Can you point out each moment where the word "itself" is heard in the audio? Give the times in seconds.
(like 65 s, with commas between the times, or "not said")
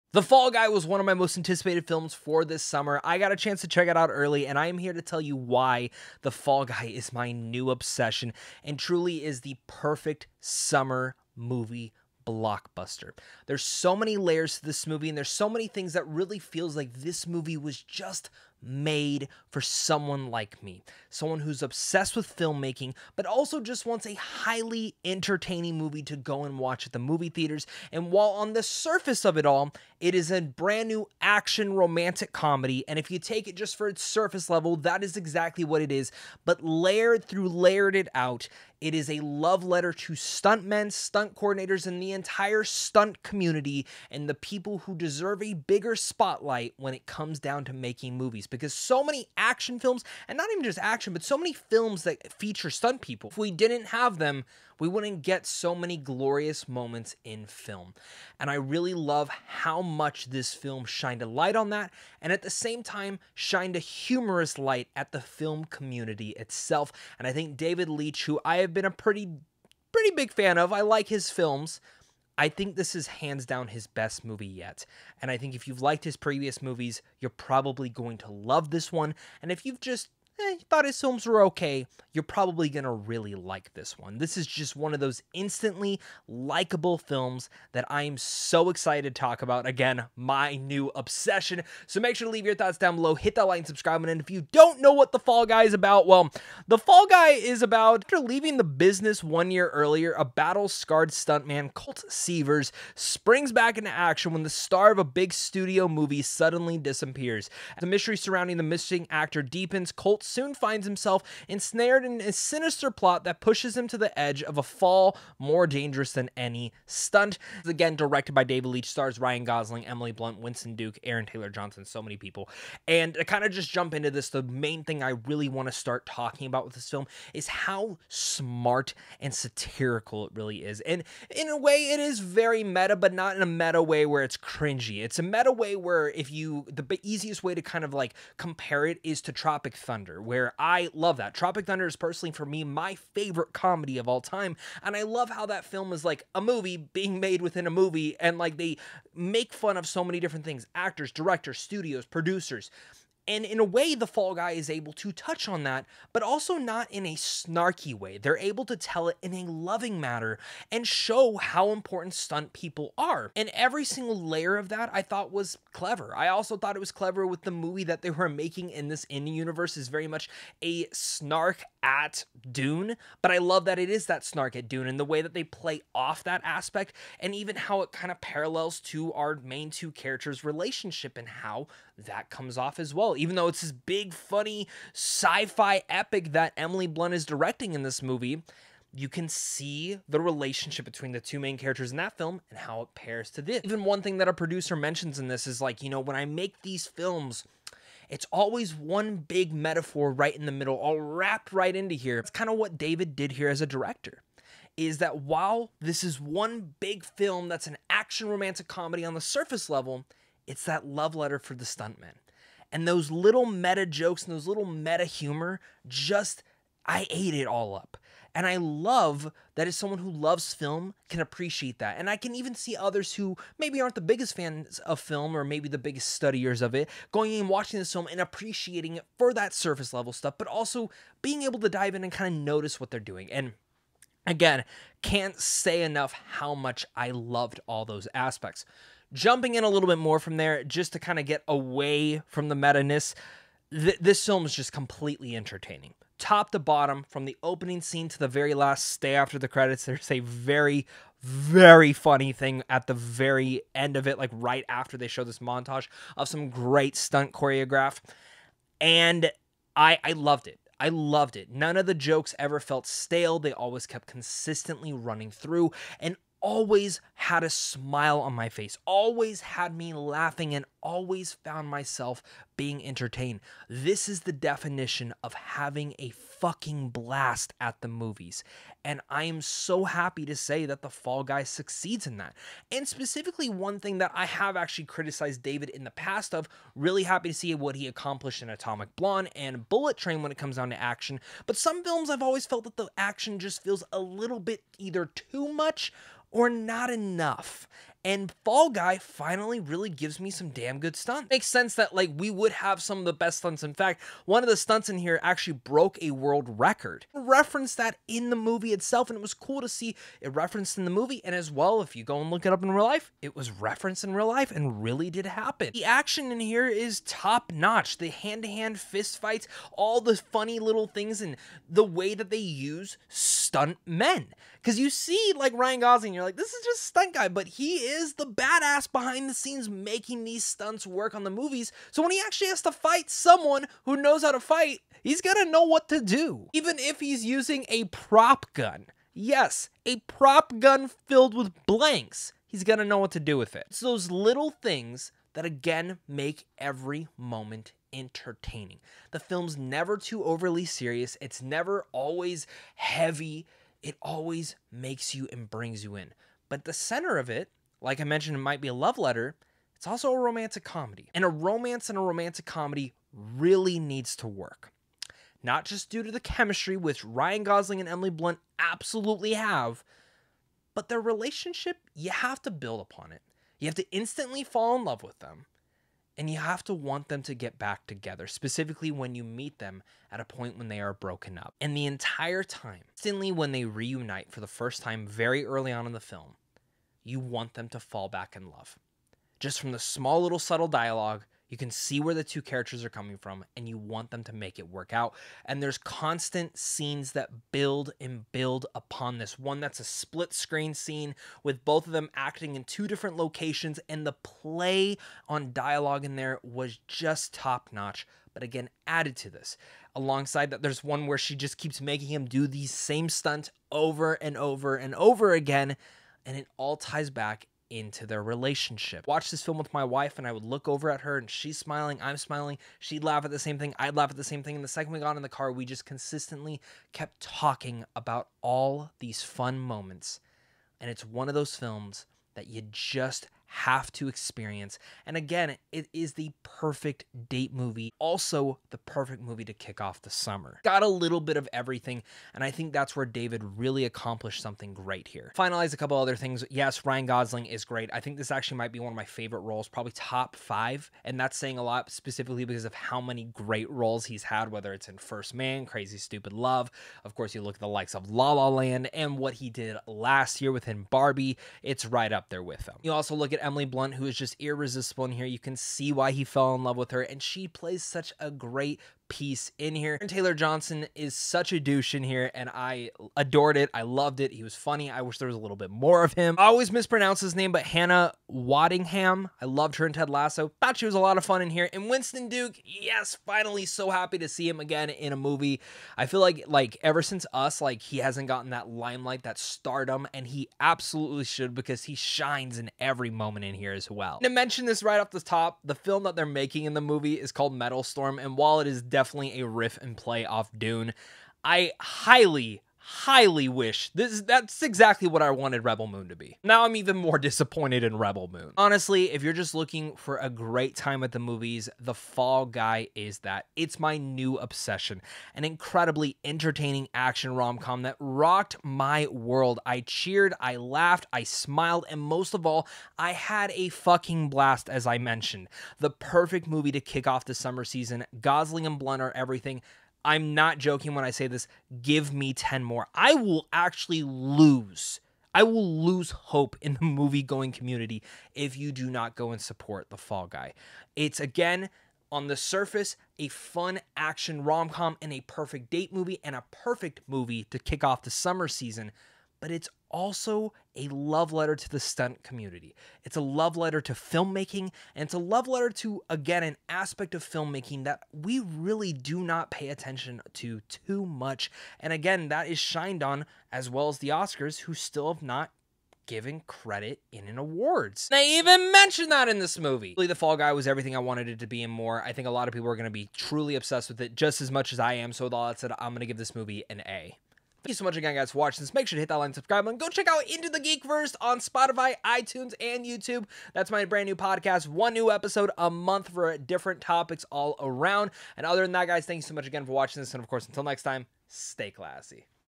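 66 s, 308 s.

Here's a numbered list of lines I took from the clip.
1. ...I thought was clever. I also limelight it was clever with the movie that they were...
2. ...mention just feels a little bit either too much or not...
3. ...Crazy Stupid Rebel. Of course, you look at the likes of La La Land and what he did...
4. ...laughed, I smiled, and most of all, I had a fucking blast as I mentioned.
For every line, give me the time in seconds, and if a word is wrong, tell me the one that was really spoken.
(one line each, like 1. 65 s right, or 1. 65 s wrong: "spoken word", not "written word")
1. 164 s wrong: "thought", not "limelight"
2. 292 s wrong: "action", not "mention"
3. 455 s wrong: "Love", not "Rebel"
4. 520 s right.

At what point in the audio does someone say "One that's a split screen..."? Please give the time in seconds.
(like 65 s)
399 s.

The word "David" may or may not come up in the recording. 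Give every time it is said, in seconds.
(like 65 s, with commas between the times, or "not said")
67 s, 118 s, 202 s, 285 s, 443 s.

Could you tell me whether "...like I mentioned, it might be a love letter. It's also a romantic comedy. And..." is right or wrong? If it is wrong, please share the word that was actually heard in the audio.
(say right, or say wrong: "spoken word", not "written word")
right.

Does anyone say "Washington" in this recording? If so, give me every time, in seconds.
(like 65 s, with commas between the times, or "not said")
not said.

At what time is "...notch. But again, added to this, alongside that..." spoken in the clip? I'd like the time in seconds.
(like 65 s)
407 s.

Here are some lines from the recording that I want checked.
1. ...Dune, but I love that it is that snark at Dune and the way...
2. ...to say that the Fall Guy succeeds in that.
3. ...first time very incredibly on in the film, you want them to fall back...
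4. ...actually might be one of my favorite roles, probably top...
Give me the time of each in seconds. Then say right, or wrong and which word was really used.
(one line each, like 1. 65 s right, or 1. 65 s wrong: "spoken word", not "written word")
1. 172 s right
2. 280 s right
3. 384 s wrong: "early", not "incredibly"
4. 448 s right.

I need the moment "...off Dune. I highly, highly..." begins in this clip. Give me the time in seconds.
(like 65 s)
500 s.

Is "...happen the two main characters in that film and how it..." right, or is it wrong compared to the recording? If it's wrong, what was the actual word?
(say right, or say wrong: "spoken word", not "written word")
wrong: "between", not "happen".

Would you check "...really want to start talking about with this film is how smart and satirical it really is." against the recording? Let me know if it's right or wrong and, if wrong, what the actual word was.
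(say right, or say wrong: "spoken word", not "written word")
right.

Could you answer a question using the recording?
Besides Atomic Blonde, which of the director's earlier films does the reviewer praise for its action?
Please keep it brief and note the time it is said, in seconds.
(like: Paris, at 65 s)
Bullet Train, at 289 s.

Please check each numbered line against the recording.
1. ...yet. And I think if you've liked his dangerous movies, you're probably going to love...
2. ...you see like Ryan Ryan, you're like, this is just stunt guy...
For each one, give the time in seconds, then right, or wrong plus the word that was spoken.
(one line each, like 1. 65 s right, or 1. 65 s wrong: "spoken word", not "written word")
1. 74 s wrong: "previous", not "dangerous"
2. 324 s wrong: "Gosling", not "Ryan".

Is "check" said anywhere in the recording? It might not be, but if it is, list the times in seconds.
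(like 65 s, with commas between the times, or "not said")
3 s, 579 s.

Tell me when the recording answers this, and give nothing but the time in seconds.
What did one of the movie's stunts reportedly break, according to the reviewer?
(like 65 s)
305 s.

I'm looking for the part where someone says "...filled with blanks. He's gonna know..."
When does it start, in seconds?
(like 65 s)
341 s.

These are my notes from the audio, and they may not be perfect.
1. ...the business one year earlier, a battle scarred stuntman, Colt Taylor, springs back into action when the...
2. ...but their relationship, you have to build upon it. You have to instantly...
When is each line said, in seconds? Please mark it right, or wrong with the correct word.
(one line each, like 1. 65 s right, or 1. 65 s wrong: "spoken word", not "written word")
1. 98 s wrong: "Seavers", not "Taylor"
2. 370 s right.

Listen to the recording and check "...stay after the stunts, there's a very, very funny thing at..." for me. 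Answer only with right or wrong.
wrong.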